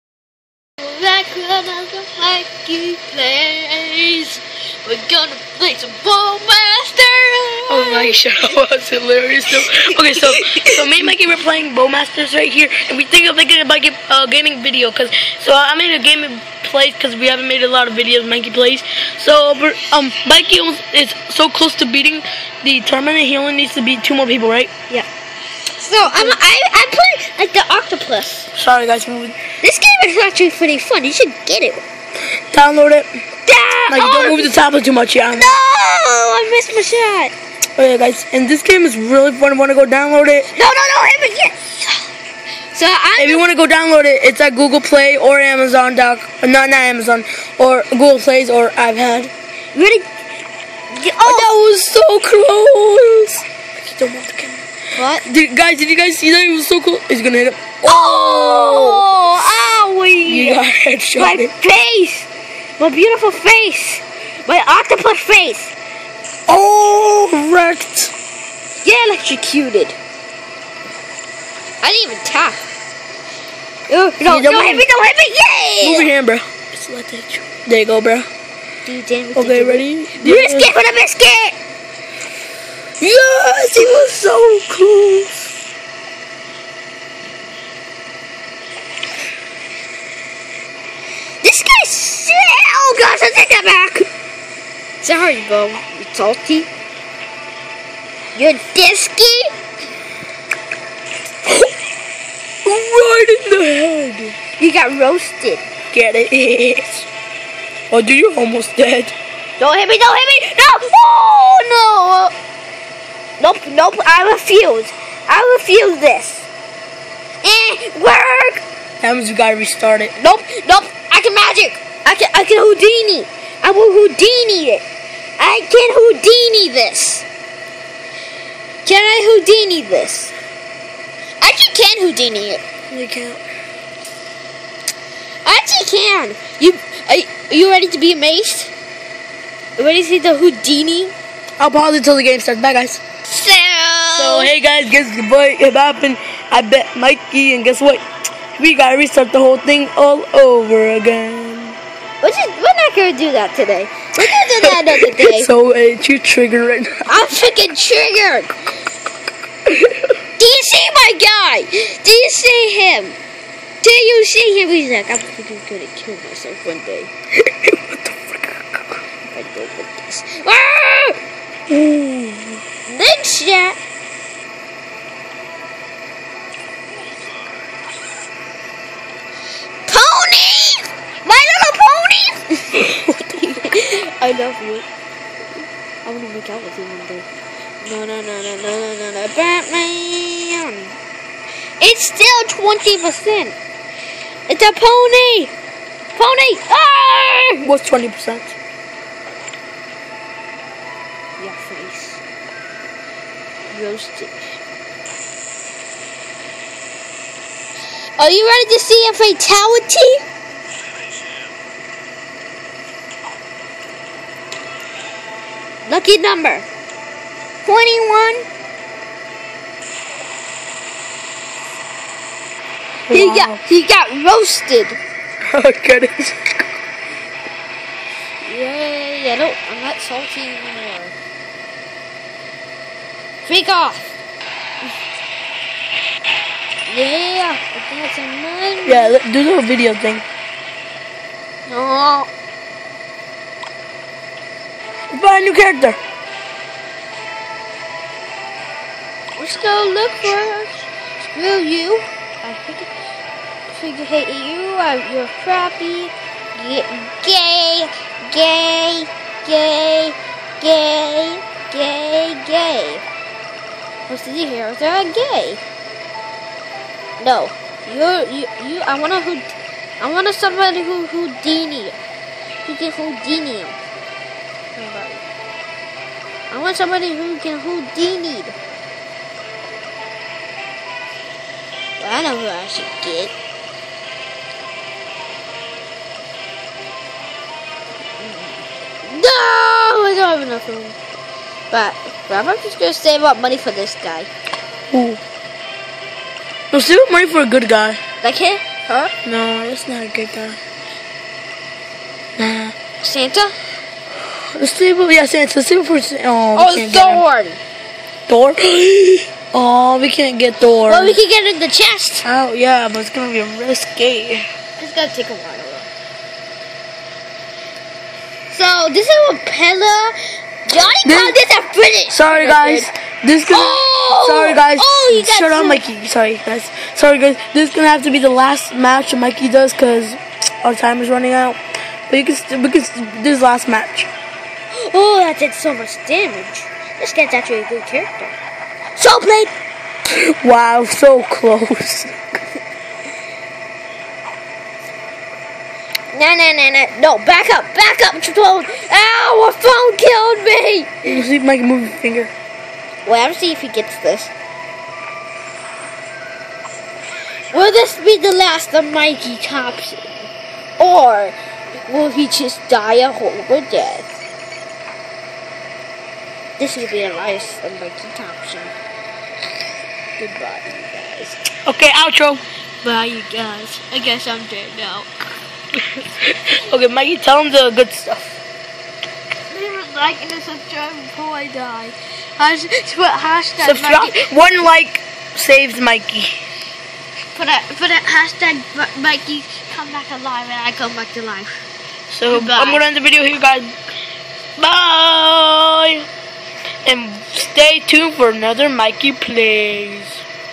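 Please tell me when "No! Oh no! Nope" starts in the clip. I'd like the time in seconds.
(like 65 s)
110 s.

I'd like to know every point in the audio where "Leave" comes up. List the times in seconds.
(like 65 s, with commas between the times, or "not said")
379 s.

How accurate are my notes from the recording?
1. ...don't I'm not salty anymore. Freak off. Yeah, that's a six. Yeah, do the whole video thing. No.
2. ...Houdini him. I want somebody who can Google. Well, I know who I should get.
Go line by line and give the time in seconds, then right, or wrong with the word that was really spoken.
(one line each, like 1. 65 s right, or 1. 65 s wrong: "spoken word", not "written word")
1. 229 s wrong: "nine", not "six"
2. 272 s wrong: "Houdini", not "Google".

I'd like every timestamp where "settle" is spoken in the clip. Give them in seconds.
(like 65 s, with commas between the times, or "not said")
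not said.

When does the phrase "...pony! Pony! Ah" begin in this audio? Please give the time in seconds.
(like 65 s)
194 s.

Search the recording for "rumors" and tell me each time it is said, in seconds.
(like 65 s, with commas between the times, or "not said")
not said.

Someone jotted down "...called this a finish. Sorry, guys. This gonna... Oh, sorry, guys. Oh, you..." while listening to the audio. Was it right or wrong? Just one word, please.
right.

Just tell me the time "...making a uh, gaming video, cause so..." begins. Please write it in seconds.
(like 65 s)
13 s.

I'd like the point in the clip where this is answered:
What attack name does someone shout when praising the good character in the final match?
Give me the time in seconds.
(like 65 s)
338 s.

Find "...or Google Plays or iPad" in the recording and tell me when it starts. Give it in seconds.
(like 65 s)
47 s.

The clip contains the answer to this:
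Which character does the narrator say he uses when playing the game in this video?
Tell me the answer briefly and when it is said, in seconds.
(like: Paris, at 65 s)
The octopus, at 27 s.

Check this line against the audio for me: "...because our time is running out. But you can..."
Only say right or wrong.
right.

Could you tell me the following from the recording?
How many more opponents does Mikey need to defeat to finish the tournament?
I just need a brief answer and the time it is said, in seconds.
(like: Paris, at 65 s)
2, at 24 s.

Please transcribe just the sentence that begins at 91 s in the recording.
Oh gosh, I take that back.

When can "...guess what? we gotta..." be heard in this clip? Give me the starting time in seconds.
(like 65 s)
147 s.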